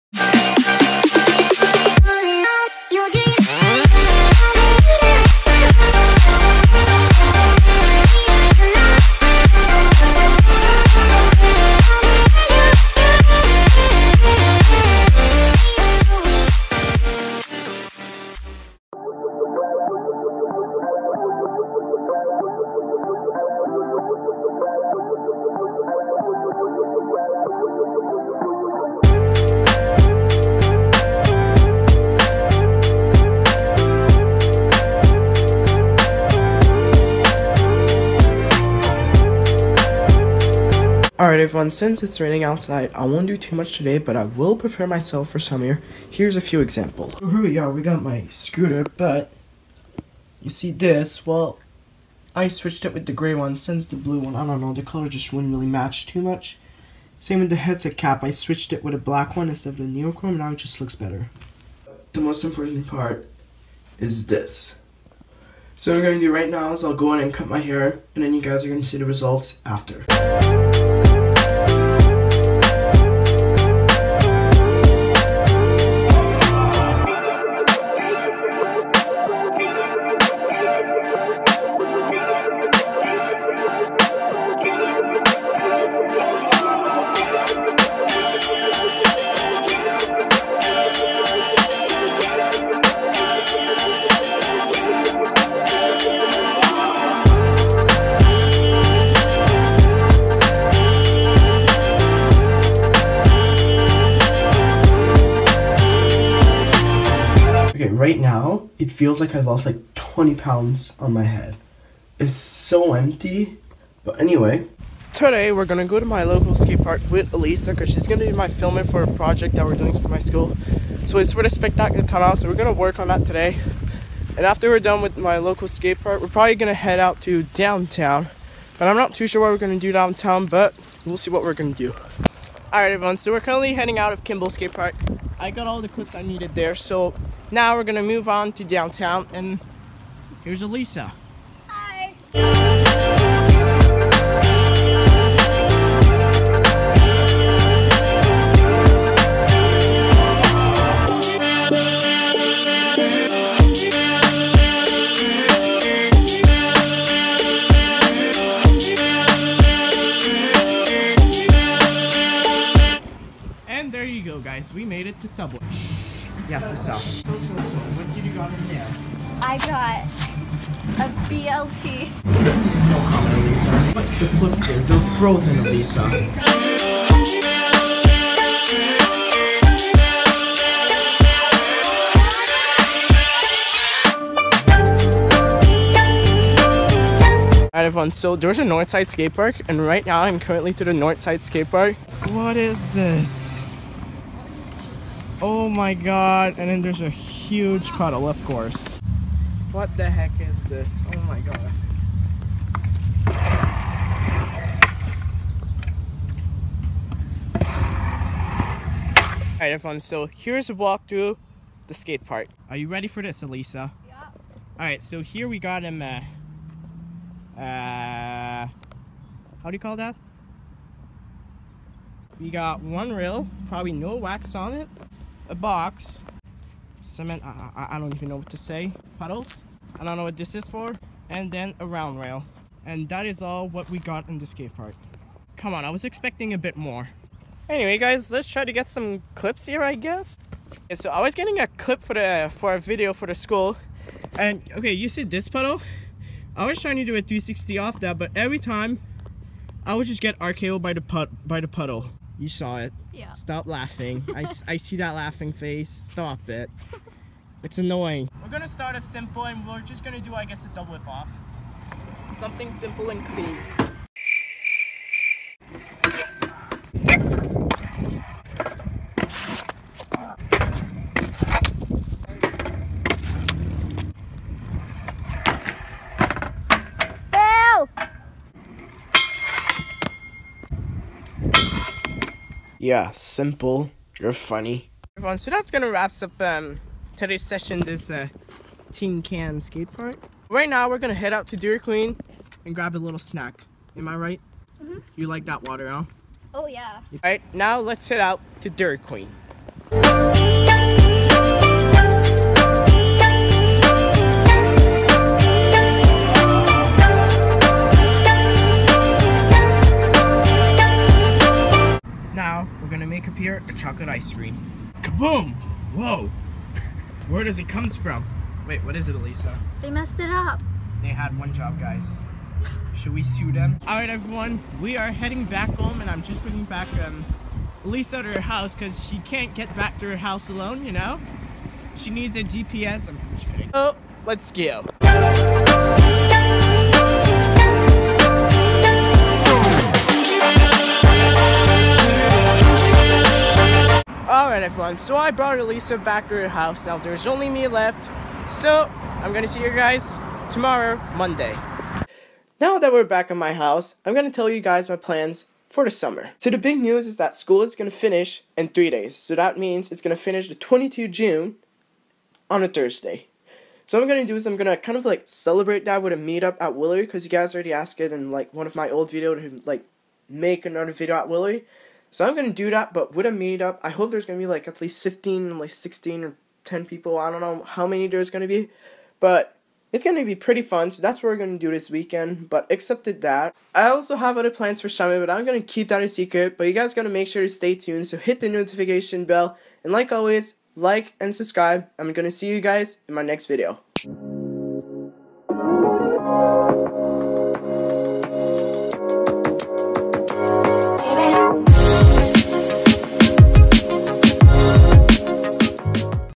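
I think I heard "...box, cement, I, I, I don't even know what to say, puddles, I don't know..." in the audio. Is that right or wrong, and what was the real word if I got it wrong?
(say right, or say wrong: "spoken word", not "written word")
right.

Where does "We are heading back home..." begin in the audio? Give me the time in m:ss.
5:24.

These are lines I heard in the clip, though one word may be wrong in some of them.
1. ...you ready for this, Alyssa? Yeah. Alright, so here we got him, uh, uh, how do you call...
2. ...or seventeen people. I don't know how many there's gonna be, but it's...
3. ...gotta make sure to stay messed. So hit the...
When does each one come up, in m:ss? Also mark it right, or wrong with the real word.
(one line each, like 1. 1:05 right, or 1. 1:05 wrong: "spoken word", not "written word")
1. 3:32 right
2. 6:16 wrong: "ten", not "seventeen"
3. 6:26 wrong: "tuned", not "messed".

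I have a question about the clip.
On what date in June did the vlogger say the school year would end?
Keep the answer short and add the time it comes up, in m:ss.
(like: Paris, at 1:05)
22 June, at 6:00.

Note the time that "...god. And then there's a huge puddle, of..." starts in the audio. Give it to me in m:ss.
3:15.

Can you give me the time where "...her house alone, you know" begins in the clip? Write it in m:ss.
5:30.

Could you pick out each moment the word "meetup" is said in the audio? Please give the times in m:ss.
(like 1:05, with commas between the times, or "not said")
6:06, 6:13.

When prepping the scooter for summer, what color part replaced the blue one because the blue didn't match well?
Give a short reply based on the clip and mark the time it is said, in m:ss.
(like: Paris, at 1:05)
gray, at 0:53.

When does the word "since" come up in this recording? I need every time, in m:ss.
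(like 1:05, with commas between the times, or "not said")
0:41, 0:53.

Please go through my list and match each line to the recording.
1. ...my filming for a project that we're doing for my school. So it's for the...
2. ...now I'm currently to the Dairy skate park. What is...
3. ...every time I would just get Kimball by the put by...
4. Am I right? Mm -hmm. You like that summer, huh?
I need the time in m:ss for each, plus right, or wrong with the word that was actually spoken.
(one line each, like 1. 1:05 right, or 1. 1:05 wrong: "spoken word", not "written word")
1. 1:58 right
2. 3:10 wrong: "Northside", not "Dairy"
3. 4:08 wrong: "RKO", not "Kimball"
4. 4:53 wrong: "water", not "summer".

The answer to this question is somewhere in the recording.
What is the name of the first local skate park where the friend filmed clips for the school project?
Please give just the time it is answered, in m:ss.
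2:14.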